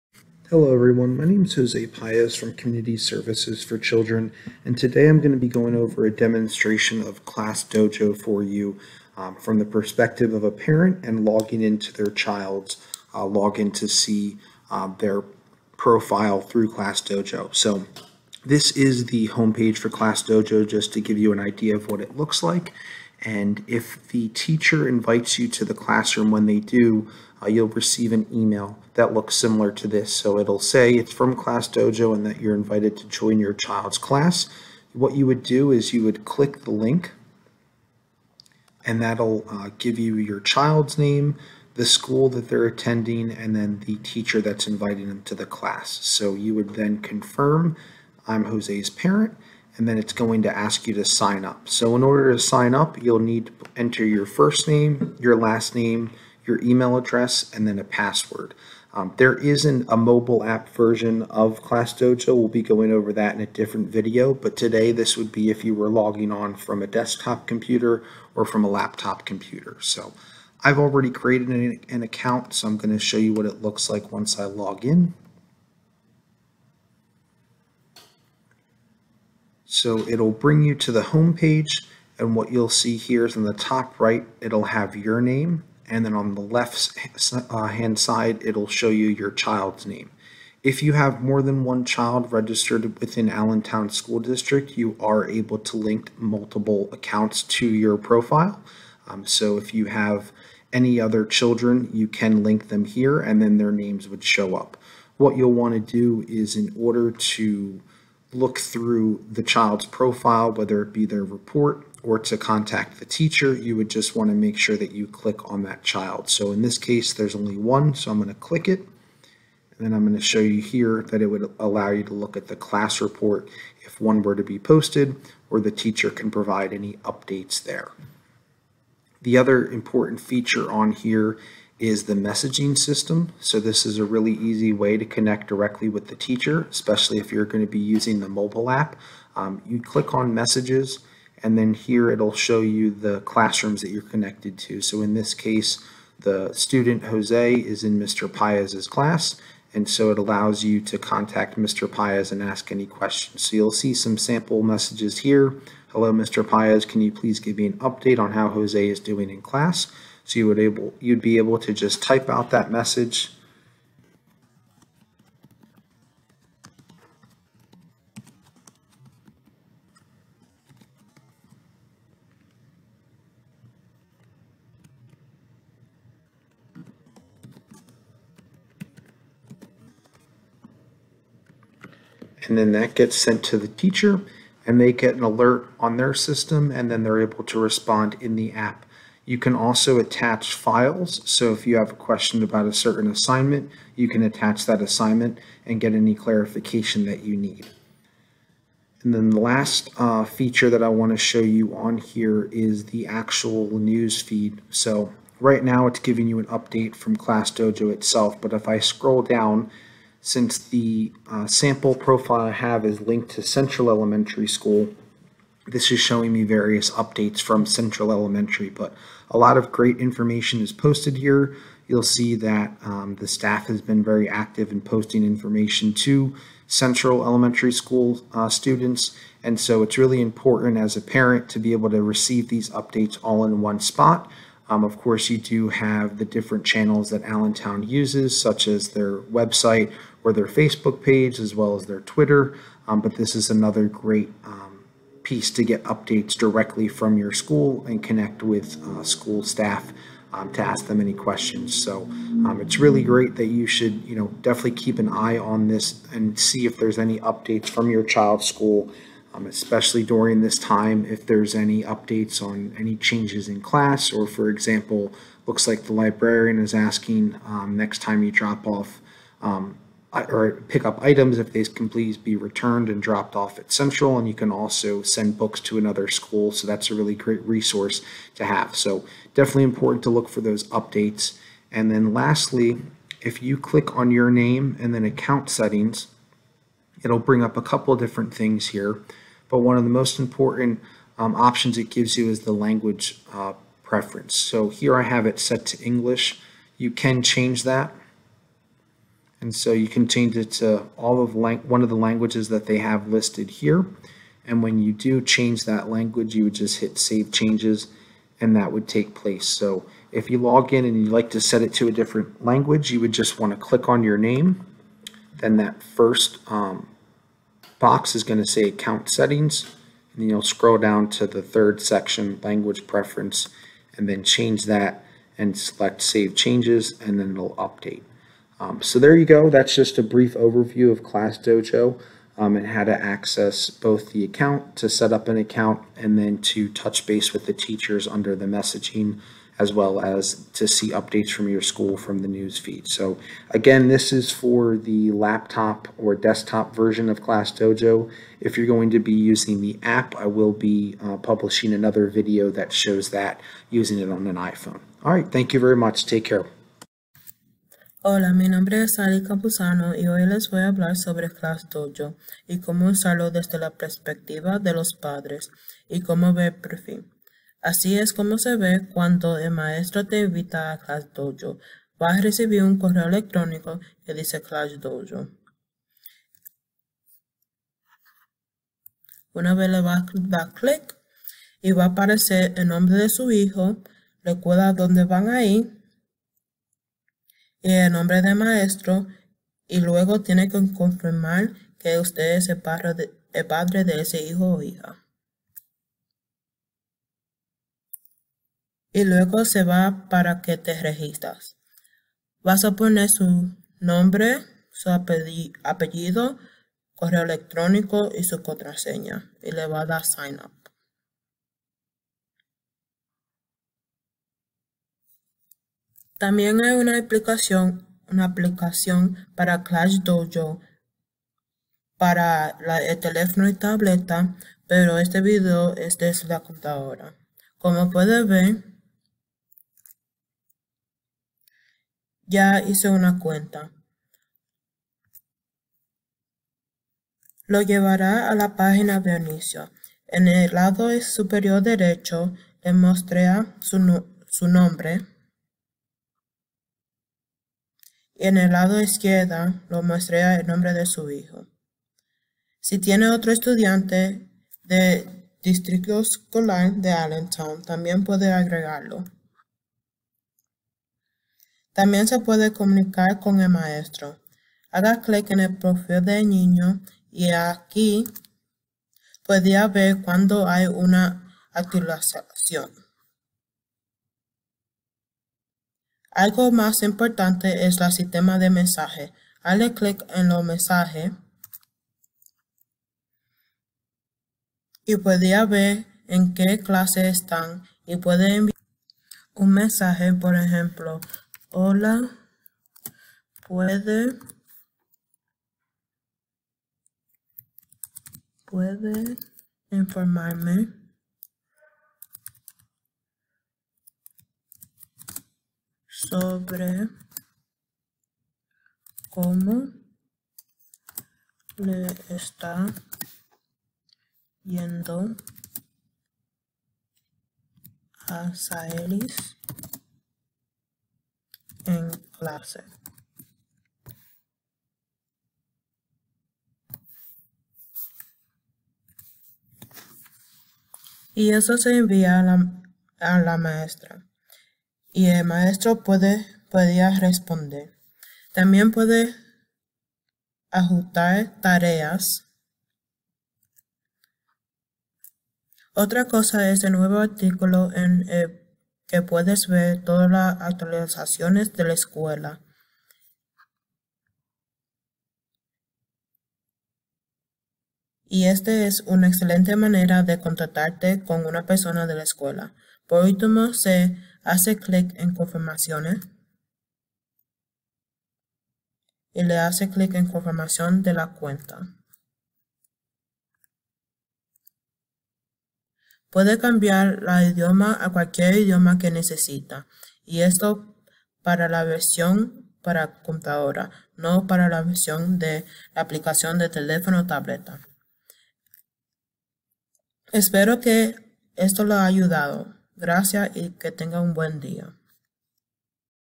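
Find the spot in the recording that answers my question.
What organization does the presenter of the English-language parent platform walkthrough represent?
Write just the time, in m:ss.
0:02.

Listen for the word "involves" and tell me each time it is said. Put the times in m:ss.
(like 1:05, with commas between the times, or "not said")
not said.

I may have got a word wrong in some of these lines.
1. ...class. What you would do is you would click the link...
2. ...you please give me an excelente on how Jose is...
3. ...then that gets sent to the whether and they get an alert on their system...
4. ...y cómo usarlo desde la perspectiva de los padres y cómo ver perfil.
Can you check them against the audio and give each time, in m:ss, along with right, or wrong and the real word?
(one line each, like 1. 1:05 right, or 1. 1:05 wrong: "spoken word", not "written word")
1. 0:33 right
2. 2:37 wrong: "update", not "excelente"
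3. 3:02 wrong: "teacher", not "whether"
4. 6:02 right.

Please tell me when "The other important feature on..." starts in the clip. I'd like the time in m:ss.
2:09.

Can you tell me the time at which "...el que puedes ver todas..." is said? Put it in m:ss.
9:08.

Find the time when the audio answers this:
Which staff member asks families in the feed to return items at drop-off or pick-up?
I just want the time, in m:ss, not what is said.
4:25.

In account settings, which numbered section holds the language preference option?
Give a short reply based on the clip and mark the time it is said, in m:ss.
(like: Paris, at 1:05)
third, at 5:21.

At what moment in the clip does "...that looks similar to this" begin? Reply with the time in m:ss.
0:28.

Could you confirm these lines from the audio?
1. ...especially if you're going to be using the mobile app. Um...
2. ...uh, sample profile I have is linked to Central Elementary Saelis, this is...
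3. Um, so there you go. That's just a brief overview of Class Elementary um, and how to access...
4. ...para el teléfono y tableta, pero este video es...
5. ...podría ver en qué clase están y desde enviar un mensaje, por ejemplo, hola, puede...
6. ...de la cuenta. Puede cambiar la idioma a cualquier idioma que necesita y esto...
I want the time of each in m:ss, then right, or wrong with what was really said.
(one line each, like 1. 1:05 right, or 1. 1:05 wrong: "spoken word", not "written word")
1. 2:16 right
2. 3:31 wrong: "School", not "Saelis"
3. 5:28 wrong: "Dojo", not "Elementary"
4. 7:01 right
5. 8:04 wrong: "puede", not "desde"
6. 9:30 right.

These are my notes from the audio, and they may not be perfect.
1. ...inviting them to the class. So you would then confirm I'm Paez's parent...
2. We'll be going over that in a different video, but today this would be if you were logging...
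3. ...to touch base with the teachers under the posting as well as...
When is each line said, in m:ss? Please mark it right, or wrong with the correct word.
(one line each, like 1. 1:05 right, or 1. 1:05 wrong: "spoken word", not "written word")
1. 0:44 wrong: "Jose", not "Paez"
2. 1:02 right
3. 5:36 wrong: "messaging", not "posting".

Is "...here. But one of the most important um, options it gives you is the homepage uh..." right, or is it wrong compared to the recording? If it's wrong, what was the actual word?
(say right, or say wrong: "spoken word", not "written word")
wrong: "language", not "homepage".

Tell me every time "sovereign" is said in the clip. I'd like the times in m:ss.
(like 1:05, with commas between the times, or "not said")
not said.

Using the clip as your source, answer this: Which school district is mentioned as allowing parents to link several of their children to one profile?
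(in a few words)
Allentown School District.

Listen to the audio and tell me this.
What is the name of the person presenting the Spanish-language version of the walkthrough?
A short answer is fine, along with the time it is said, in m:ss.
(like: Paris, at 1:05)
Ali Capuzano, at 5:58.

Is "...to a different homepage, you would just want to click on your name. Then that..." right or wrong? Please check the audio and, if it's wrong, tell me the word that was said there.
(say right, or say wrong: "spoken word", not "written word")
wrong: "language", not "homepage".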